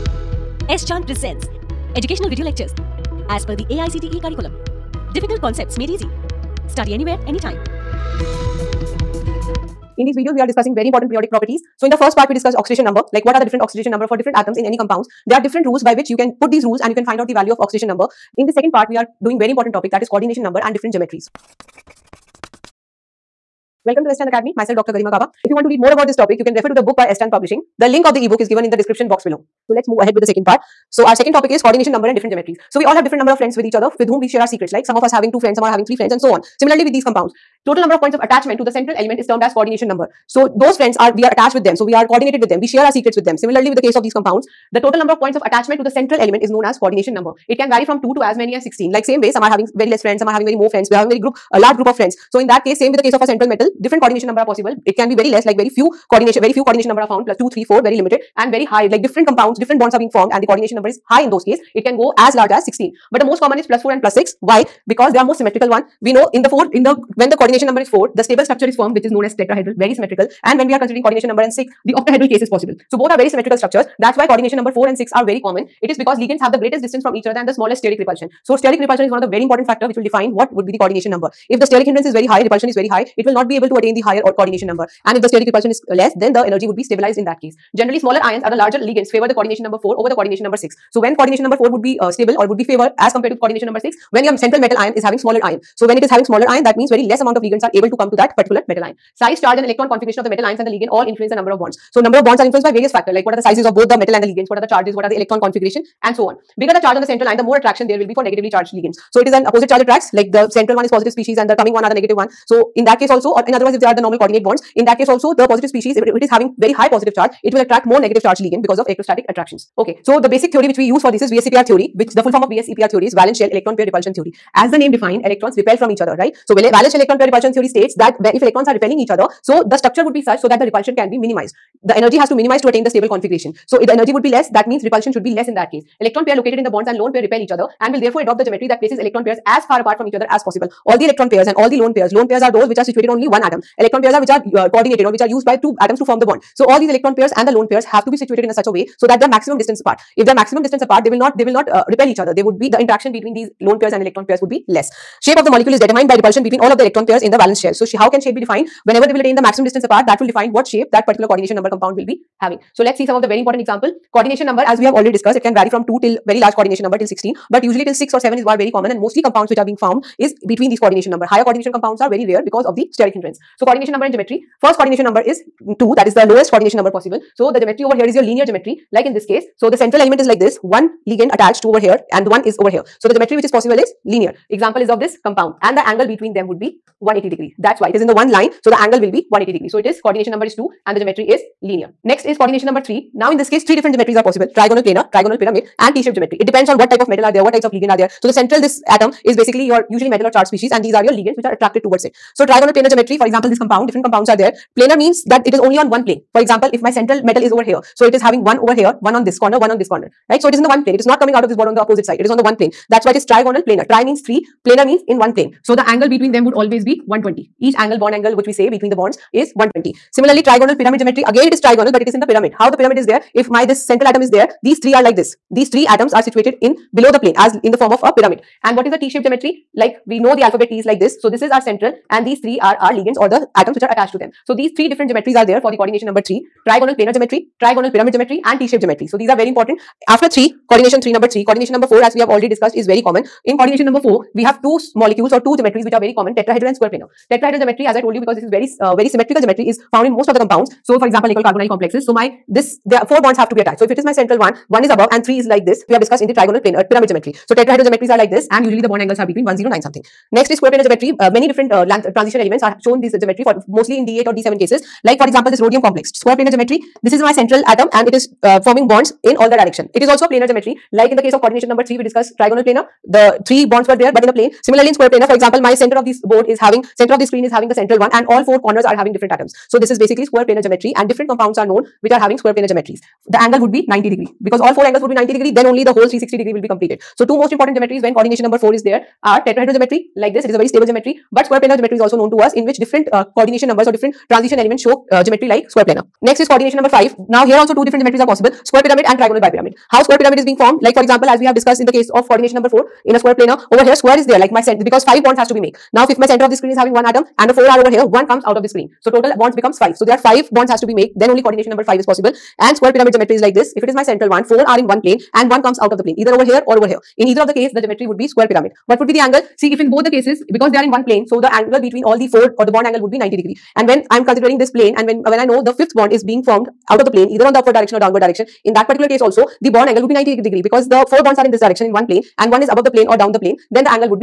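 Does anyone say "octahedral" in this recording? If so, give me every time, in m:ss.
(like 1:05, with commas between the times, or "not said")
1:11.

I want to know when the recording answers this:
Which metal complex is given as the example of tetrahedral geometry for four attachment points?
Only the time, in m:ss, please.
4:11.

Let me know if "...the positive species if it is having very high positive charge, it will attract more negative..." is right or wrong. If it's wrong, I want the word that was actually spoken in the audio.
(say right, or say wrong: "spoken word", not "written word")
right.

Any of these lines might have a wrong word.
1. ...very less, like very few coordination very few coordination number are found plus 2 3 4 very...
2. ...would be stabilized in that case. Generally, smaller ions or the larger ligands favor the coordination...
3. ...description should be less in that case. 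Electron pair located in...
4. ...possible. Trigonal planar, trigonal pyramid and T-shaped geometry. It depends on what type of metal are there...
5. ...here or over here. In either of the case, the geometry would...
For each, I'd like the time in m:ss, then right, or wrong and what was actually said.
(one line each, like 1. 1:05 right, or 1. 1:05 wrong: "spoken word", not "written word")
1. 0:55 right
2. 1:26 right
3. 2:14 wrong: "repulsion", not "description"
4. 3:14 right
5. 5:16 right.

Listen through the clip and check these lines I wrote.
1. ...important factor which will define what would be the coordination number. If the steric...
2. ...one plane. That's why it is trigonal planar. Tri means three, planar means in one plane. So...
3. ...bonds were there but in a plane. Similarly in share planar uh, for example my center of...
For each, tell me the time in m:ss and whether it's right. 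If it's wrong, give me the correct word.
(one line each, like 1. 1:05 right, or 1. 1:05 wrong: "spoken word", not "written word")
1. 1:19 right
2. 3:32 right
3. 4:33 wrong: "square", not "share".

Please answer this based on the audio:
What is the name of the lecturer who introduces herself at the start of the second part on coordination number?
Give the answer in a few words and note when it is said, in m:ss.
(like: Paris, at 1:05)
Dr. Garima Gaba, at 0:24.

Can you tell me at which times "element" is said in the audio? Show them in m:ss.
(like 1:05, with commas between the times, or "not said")
0:38, 0:46, 2:59, 4:22, 4:54.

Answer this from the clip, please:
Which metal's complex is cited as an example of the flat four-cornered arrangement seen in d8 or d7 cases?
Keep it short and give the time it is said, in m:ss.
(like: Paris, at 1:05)
rhodium, at 4:25.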